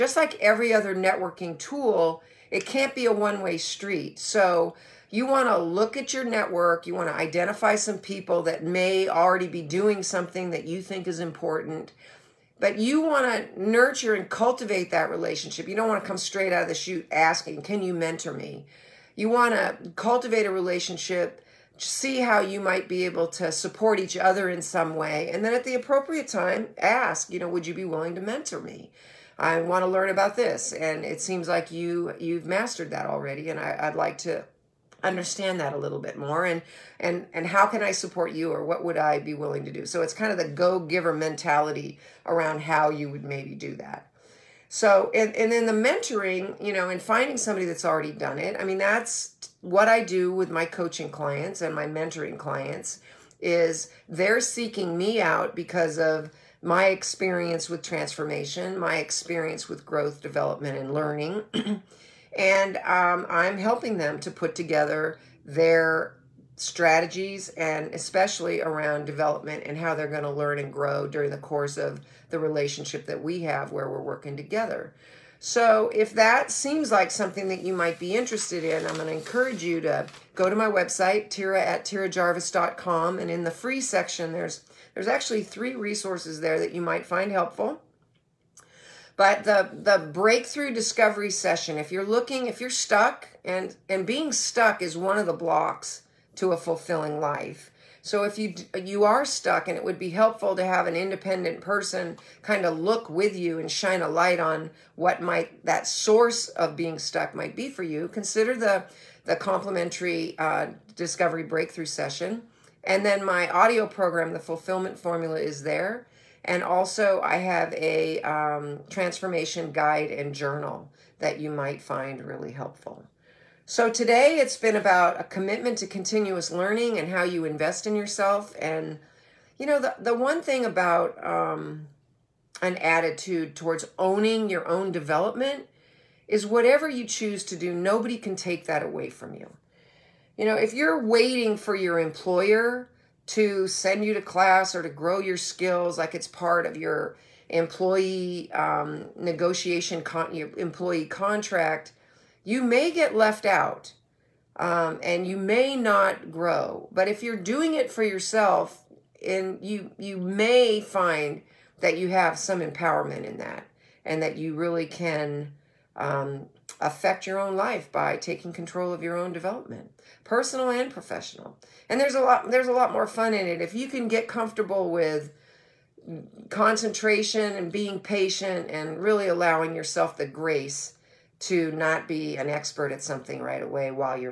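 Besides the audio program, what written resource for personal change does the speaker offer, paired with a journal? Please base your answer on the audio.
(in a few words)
transformation guide.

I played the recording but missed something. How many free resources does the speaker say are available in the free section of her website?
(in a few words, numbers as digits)
3.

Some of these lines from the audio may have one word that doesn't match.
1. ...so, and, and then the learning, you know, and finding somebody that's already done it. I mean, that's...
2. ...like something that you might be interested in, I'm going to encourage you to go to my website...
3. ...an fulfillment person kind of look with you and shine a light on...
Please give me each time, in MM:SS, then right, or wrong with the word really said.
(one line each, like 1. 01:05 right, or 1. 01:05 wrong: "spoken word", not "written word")
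1. 00:44 wrong: "mentoring", not "learning"
2. 01:16 right
3. 01:40 wrong: "independent", not "fulfillment".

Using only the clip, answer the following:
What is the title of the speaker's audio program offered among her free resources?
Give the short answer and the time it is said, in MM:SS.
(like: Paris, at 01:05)
The Fulfillment Formula, at 01:54.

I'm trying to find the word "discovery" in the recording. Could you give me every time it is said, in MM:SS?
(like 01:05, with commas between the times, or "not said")
01:30, 01:50.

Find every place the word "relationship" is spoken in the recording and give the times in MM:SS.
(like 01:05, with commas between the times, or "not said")
00:15, 00:20, 01:12.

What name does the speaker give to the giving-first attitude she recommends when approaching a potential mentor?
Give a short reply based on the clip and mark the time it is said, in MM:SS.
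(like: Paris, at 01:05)
go giver mentality, at 00:40.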